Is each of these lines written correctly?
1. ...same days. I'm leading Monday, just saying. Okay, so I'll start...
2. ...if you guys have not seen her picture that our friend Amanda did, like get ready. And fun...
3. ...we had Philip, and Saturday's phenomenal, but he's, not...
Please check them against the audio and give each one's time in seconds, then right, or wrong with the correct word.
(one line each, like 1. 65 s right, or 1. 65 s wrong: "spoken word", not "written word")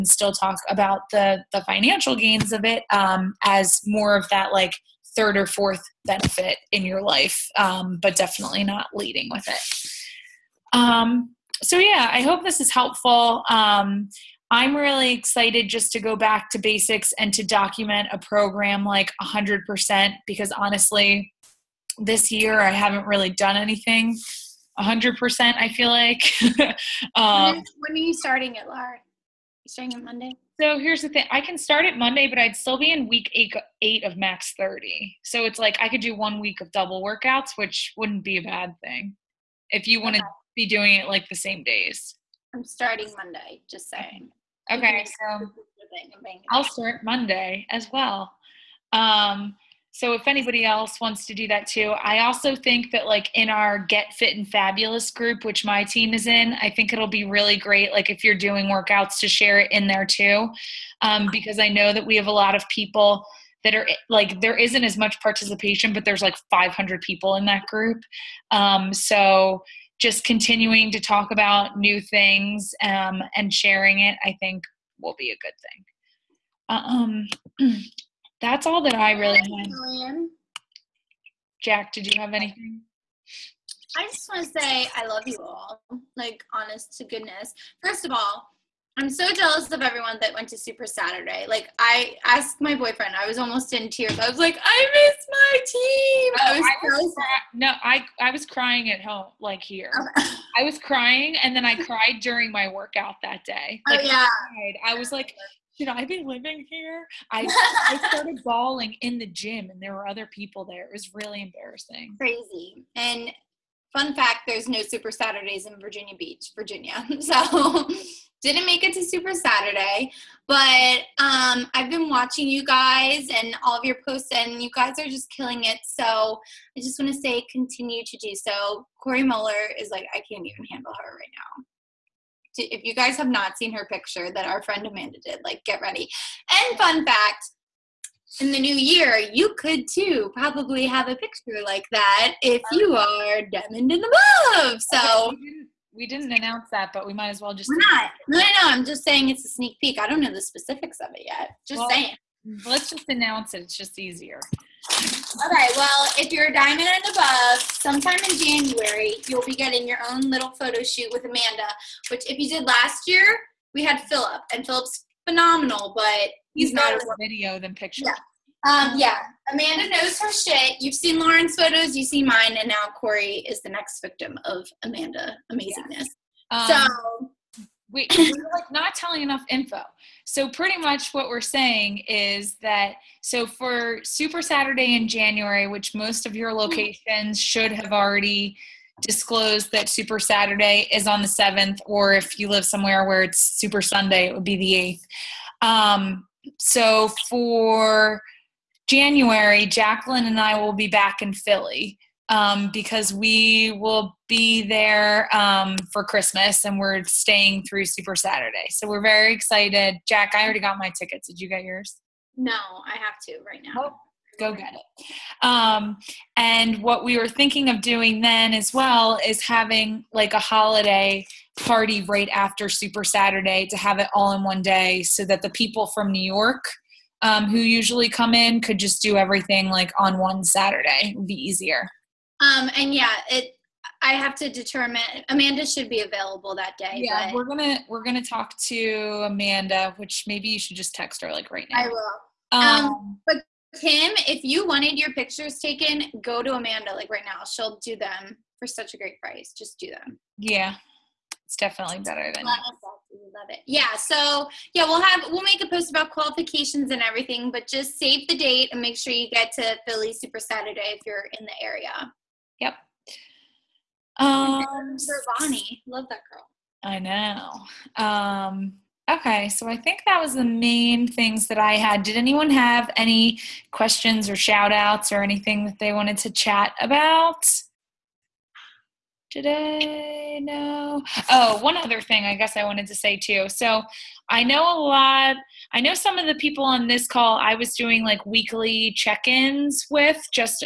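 1. 41 s wrong: "starting", not "leading"
2. 132 s right
3. 163 s wrong: "Philip", not "Saturday".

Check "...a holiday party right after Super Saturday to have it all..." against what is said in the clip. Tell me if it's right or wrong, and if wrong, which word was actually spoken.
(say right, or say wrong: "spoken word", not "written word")
right.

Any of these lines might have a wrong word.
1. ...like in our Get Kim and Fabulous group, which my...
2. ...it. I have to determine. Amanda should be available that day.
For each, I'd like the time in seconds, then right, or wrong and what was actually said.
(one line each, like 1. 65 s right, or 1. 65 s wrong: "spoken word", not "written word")
1. 53 s wrong: "Fit", not "Kim"
2. 233 s right.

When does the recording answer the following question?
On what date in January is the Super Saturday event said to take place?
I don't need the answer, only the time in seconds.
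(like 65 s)
191 s.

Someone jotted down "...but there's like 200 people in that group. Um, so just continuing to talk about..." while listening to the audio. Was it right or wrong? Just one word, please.
wrong.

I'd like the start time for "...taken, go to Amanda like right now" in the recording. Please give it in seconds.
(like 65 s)
245 s.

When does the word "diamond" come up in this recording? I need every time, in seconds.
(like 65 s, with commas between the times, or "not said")
143 s, 156 s.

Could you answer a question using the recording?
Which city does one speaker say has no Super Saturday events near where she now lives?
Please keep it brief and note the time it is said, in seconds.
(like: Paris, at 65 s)
Virginia Beach, at 115 s.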